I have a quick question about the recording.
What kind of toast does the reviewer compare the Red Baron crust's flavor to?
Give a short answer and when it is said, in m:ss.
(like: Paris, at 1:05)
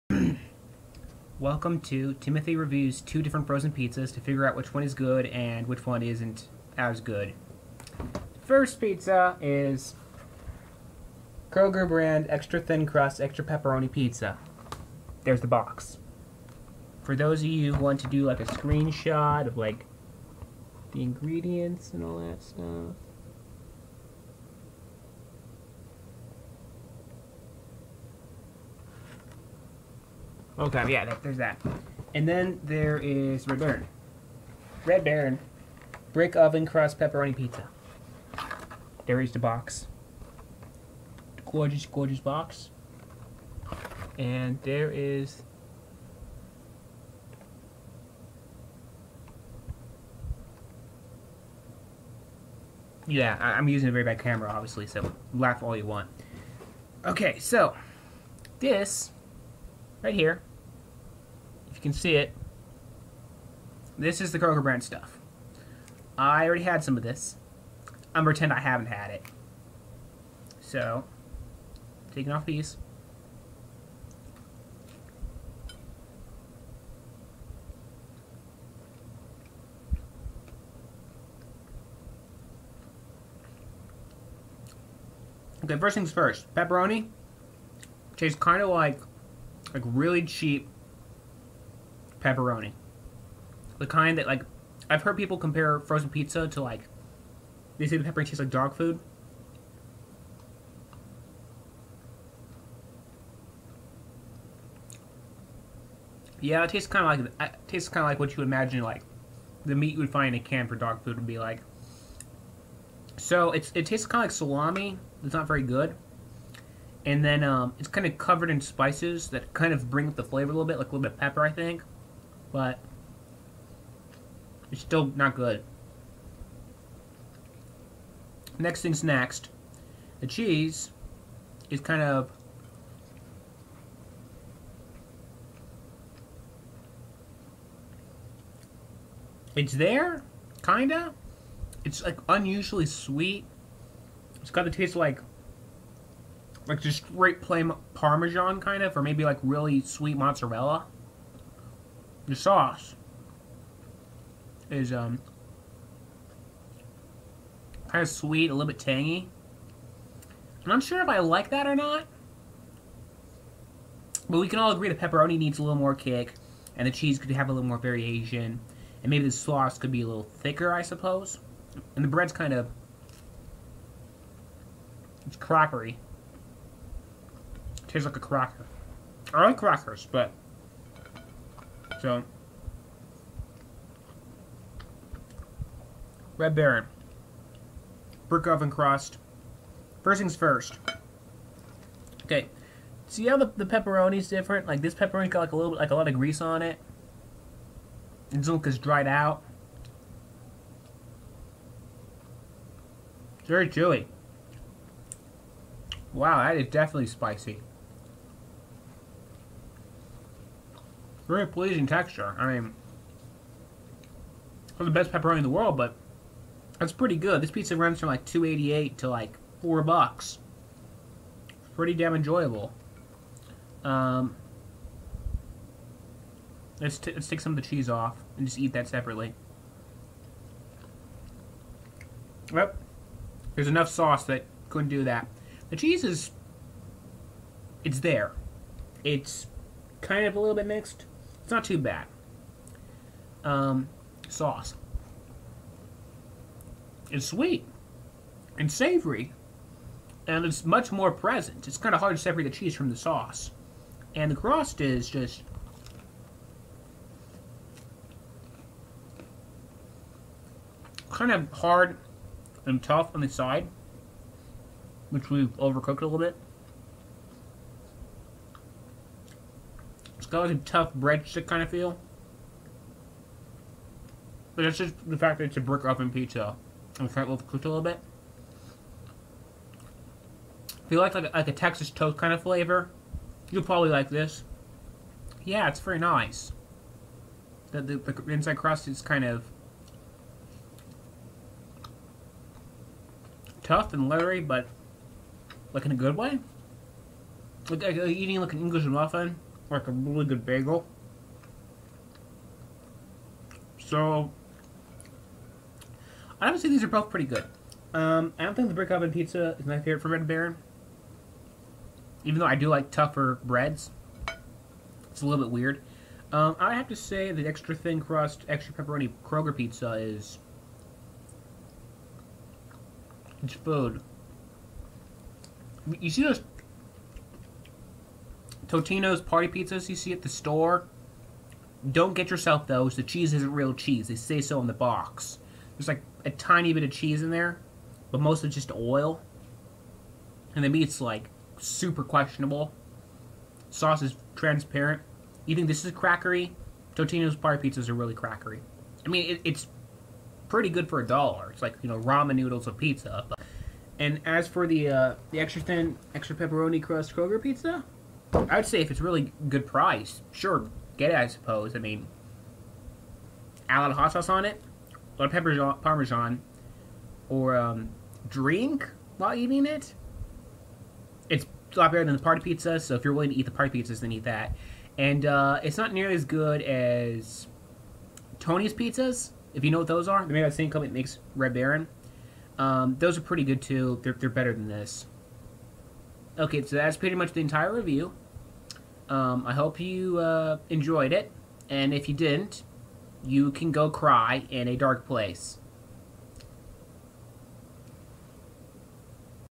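Texas toast, at 4:41.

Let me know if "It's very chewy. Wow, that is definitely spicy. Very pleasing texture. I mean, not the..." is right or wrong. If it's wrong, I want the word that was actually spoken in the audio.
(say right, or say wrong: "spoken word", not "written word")
right.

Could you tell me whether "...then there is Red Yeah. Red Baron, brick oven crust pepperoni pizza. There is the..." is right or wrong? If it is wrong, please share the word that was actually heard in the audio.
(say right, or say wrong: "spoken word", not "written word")
wrong: "Baron", not "Yeah".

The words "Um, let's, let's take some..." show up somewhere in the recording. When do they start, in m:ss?
3:43.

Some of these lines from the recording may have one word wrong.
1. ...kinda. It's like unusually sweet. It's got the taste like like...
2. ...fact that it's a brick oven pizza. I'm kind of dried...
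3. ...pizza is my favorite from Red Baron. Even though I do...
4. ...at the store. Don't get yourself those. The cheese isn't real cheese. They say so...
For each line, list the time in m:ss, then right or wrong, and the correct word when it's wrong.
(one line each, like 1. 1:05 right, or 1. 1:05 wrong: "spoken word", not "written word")
1. 2:20 right
2. 4:35 wrong: "cooked", not "dried"
3. 5:09 right
4. 5:30 right.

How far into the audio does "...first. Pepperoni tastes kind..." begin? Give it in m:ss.
1:26.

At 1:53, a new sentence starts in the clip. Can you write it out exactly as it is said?
So it's it tastes kind of like salami.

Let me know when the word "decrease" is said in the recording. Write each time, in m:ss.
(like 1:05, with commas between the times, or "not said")
not said.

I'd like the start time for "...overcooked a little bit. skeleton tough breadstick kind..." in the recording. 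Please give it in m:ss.
4:25.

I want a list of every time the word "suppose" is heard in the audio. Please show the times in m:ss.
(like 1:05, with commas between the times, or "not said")
2:50, 6:01.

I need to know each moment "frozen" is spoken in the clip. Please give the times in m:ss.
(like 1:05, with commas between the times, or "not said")
0:03, 1:35.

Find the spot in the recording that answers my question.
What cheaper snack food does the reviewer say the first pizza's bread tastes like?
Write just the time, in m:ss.
2:57.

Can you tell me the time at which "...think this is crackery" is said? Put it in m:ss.
5:45.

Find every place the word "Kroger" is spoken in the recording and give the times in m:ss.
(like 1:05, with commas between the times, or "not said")
0:11, 1:04, 5:19, 5:57.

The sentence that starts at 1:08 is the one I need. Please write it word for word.
I'm pretend I haven't had it.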